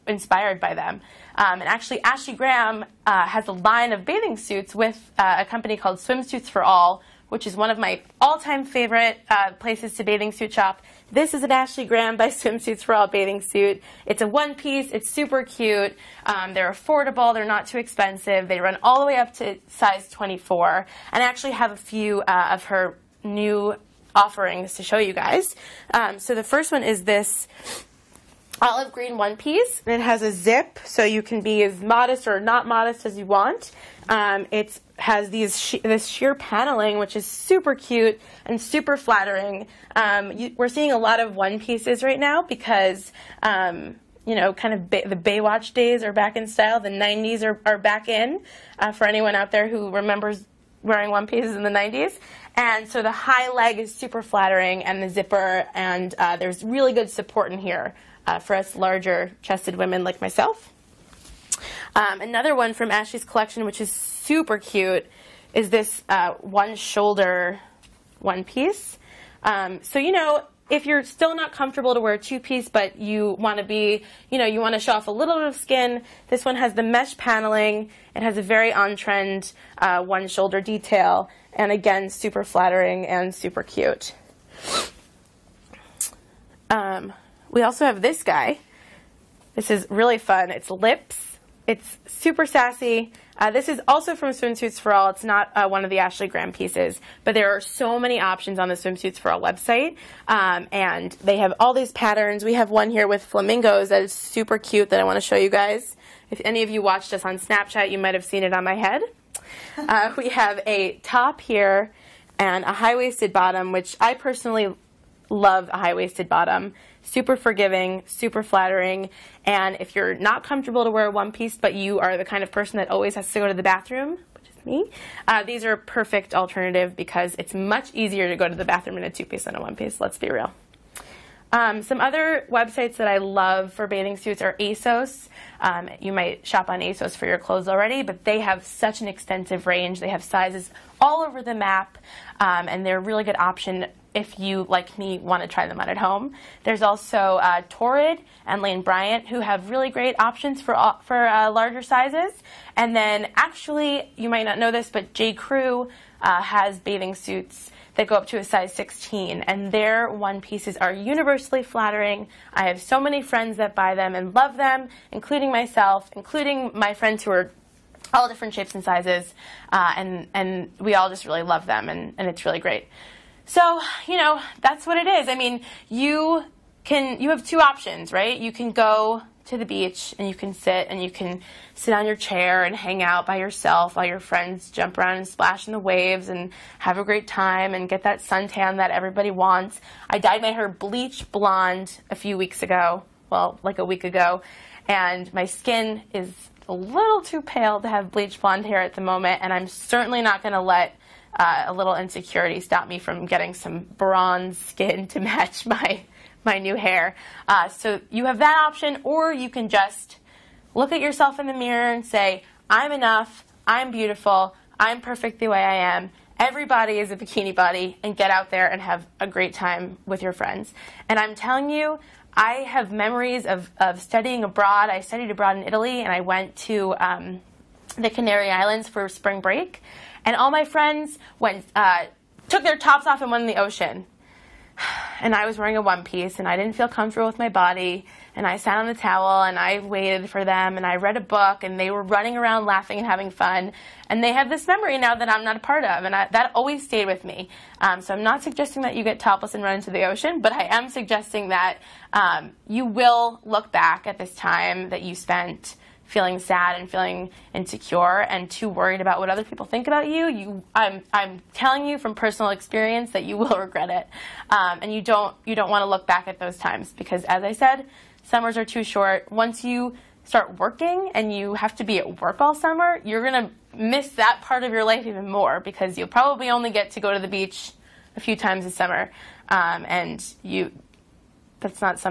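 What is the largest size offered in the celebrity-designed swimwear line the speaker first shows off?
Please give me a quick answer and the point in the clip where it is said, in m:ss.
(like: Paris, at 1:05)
24, at 0:19.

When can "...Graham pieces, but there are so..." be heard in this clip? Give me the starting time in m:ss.
1:36.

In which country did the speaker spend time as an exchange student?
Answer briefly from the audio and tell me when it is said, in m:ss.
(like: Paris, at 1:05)
Italy, at 3:45.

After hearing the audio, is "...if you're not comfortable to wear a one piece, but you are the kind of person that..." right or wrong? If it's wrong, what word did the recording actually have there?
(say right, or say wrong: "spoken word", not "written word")
right.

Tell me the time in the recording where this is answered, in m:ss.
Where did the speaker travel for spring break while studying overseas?
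3:48.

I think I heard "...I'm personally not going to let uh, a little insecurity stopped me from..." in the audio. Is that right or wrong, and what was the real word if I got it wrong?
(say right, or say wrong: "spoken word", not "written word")
wrong: "certainly", not "personally".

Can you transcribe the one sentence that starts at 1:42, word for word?
We have one here with flamingos that is super cute that I want to show you guys.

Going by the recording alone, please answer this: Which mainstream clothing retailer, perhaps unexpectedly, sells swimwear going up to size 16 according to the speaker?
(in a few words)
J. Crew.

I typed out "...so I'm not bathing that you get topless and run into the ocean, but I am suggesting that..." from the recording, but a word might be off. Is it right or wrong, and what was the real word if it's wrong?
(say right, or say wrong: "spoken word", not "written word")
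wrong: "suggesting", not "bathing".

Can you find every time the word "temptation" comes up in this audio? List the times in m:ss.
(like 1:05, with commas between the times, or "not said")
not said.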